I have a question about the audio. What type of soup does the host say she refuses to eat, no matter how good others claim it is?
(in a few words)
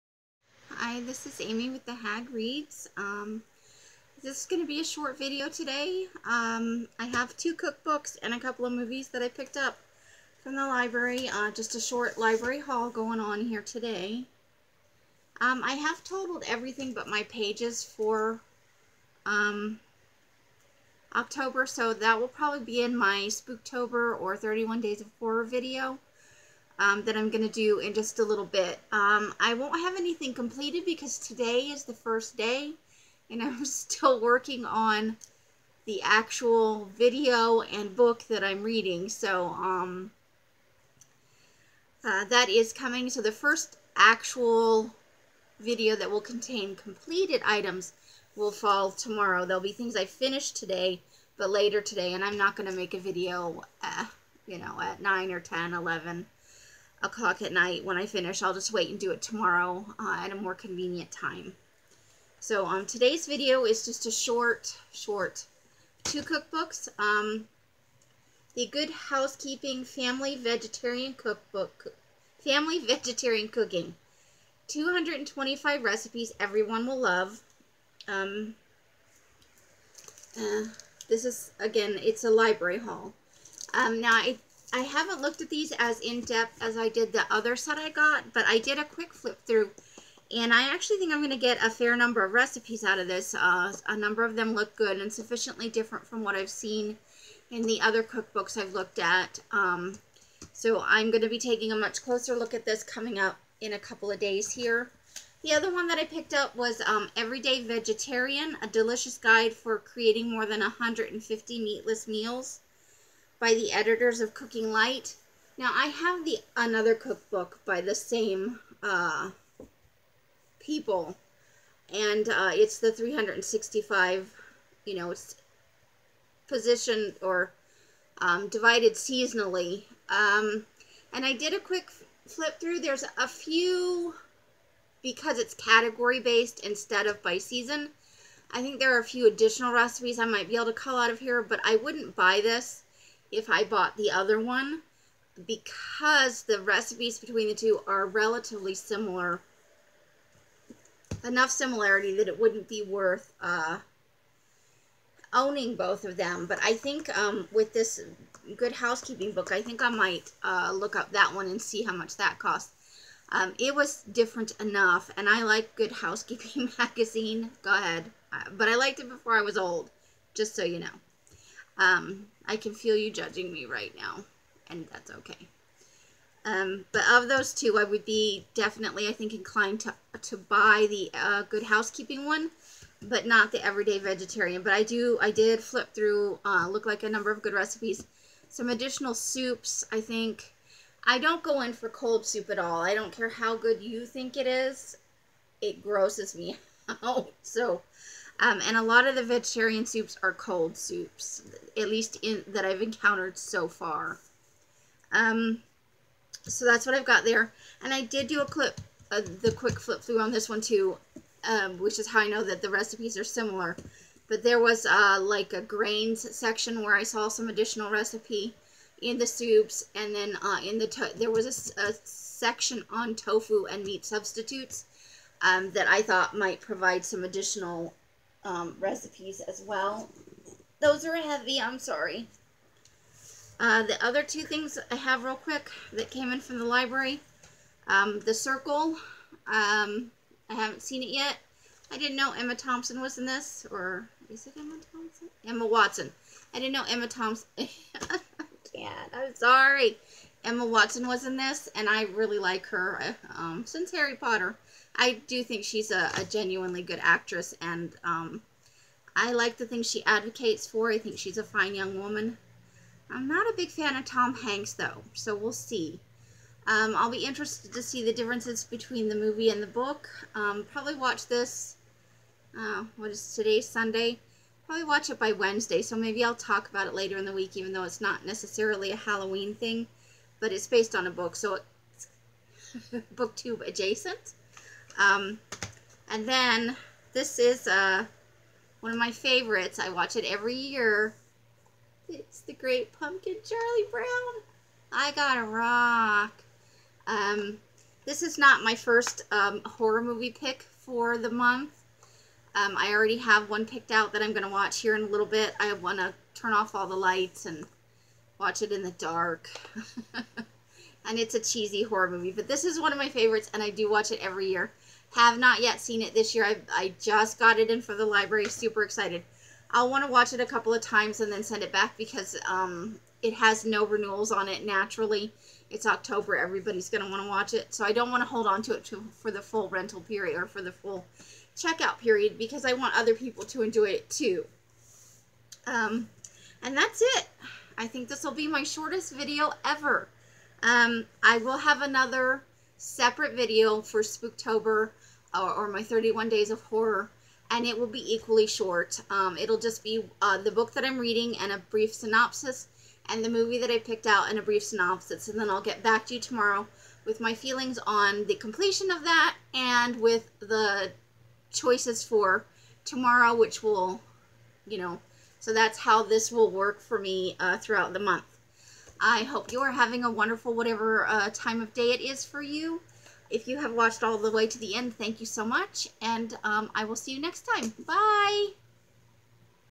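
Cold soup.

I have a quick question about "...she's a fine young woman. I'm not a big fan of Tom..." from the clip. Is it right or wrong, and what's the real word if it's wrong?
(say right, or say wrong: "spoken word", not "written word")
right.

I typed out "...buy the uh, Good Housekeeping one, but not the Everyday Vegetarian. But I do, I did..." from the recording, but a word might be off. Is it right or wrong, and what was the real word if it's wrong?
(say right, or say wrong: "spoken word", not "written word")
right.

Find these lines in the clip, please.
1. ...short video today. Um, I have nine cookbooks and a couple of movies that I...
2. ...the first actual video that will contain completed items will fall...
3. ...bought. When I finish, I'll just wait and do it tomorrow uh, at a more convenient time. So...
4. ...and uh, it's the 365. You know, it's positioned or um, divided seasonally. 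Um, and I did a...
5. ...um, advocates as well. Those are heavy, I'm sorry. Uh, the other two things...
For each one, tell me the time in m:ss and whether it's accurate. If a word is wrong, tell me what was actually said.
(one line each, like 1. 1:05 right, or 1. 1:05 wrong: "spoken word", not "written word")
1. 0:04 wrong: "two", not "nine"
2. 0:43 right
3. 0:57 wrong: "night", not "bought"
4. 2:01 right
5. 3:48 wrong: "recipes", not "advocates".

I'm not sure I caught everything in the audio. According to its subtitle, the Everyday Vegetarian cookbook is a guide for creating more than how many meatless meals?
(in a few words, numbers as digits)
150.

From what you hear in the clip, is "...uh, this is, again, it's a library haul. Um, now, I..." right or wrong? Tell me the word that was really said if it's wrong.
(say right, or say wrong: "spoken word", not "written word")
right.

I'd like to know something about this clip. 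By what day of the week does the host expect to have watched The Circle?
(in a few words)
Wednesday.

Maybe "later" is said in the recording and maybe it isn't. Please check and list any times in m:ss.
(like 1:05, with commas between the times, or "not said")
0:51, 4:36.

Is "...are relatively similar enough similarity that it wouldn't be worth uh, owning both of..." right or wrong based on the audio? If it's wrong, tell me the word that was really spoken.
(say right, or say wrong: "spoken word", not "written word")
right.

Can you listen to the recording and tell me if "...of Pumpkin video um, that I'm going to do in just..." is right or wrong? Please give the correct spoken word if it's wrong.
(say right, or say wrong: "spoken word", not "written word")
wrong: "Horror", not "Pumpkin".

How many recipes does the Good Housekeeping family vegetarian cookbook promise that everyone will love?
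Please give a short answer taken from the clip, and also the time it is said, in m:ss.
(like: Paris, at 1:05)
225, at 1:14.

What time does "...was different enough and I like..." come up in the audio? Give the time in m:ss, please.
2:43.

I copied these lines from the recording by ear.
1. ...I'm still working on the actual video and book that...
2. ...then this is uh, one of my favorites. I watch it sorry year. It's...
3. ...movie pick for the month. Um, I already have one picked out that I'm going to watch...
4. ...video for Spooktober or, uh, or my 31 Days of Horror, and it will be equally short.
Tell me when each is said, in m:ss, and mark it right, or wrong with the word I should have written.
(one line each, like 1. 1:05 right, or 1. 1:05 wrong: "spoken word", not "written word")
1. 0:33 right
2. 4:46 wrong: "every", not "sorry"
3. 5:00 right
4. 5:43 right.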